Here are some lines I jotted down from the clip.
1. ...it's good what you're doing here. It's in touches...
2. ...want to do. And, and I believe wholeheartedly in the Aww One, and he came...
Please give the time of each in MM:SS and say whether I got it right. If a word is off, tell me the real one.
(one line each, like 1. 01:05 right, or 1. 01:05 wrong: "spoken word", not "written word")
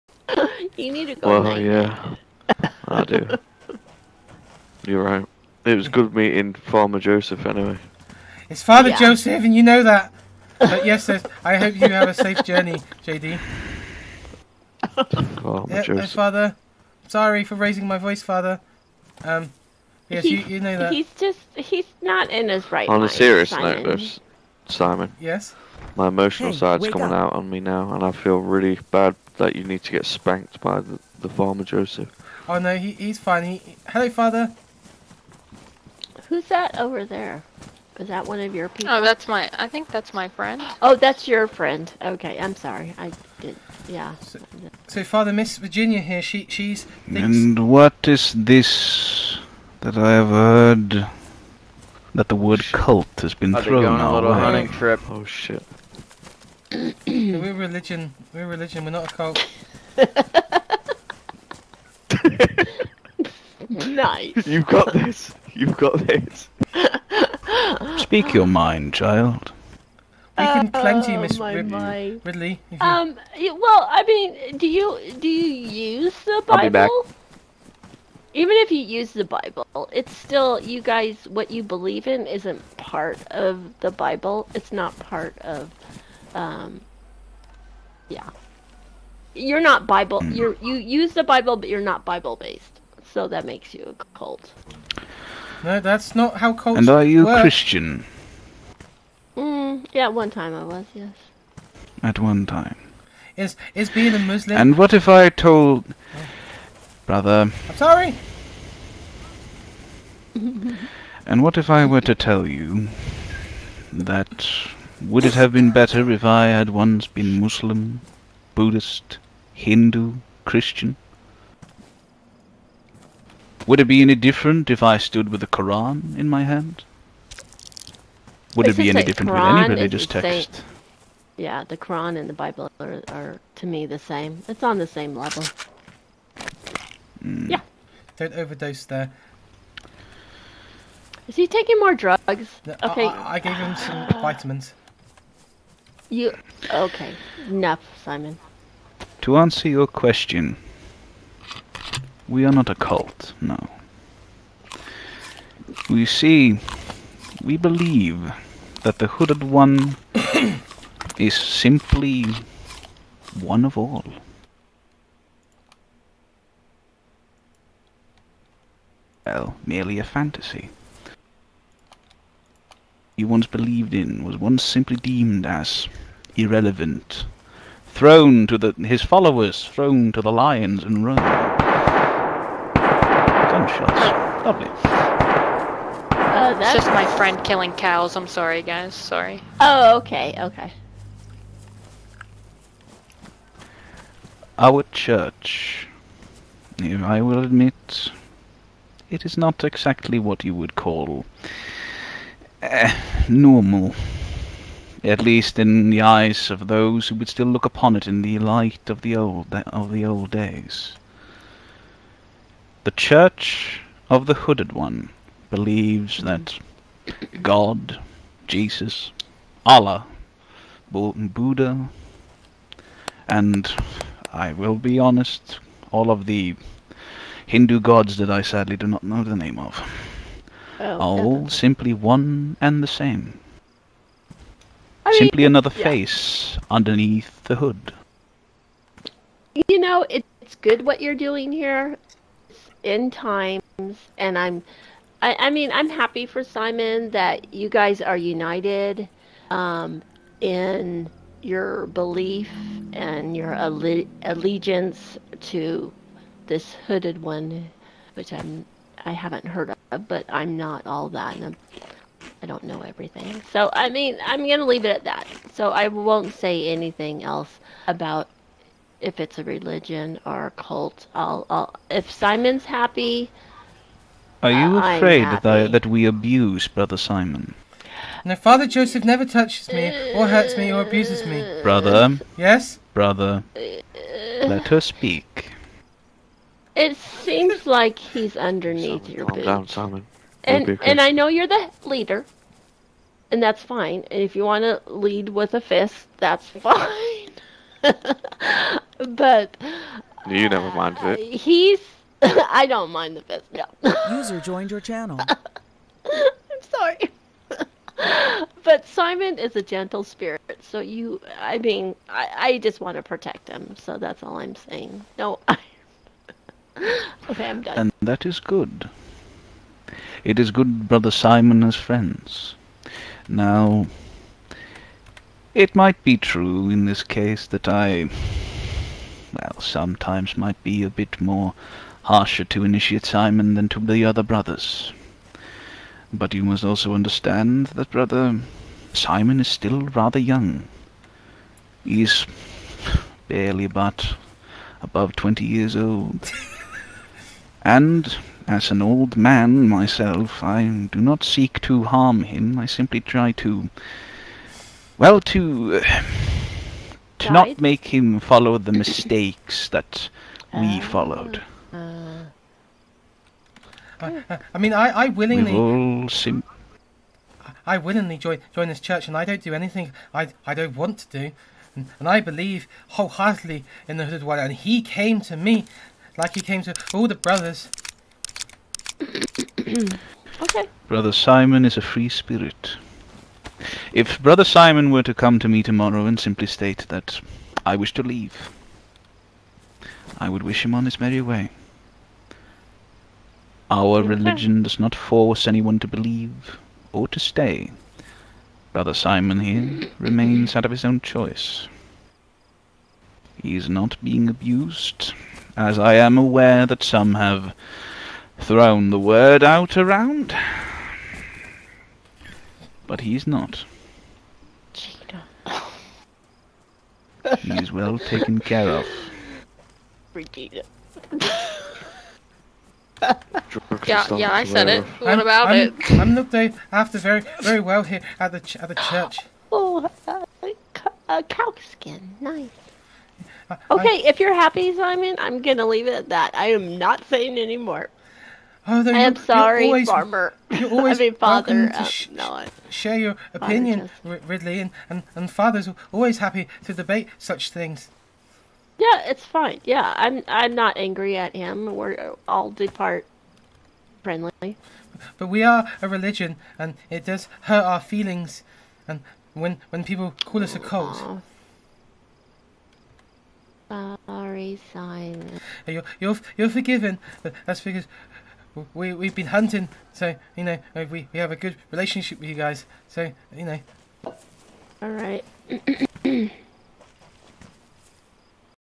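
1. 04:00 wrong: "times", not "touches"
2. 06:10 wrong: "Hooded", not "Aww".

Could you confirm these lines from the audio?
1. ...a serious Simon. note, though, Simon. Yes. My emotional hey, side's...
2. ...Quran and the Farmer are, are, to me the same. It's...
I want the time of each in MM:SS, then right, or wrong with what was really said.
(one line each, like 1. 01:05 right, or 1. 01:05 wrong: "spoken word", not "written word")
1. 00:23 right
2. 02:11 wrong: "Bible", not "Farmer".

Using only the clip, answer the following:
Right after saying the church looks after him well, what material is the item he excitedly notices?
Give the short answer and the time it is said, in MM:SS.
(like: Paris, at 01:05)
Cow skin, at 07:11.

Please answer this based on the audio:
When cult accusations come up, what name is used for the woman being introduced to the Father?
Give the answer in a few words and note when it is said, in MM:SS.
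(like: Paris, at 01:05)
Virginia, at 00:45.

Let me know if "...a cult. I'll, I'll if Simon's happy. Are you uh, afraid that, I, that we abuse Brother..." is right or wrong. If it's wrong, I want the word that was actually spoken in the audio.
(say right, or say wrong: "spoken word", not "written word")
right.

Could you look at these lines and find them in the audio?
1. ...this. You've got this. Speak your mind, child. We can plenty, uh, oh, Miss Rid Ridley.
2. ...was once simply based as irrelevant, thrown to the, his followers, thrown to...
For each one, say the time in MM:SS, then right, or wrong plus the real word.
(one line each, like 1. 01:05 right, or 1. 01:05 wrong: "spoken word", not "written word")
1. 01:04 right
2. 02:54 wrong: "deemed", not "based".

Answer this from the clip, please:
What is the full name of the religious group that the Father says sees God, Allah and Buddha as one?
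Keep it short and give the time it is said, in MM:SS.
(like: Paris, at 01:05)
Church of the Hooded One, at 03:32.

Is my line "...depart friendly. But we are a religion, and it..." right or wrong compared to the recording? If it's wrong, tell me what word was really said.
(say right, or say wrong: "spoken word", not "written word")
right.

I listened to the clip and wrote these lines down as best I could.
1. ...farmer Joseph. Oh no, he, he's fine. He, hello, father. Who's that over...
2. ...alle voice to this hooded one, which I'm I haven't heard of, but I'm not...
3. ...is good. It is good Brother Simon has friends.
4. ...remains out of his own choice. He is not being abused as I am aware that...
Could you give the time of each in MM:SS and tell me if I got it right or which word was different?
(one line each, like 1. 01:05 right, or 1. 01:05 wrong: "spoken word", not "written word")
1. 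00:31 right
2. 04:13 wrong: "allegiance", not "voice"
3. 05:18 right
4. 06:39 right.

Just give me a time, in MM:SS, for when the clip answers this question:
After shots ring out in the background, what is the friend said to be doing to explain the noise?
03:07.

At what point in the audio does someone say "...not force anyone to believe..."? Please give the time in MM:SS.
06:34.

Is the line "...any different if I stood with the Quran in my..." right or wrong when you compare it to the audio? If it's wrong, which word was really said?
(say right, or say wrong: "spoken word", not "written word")
right.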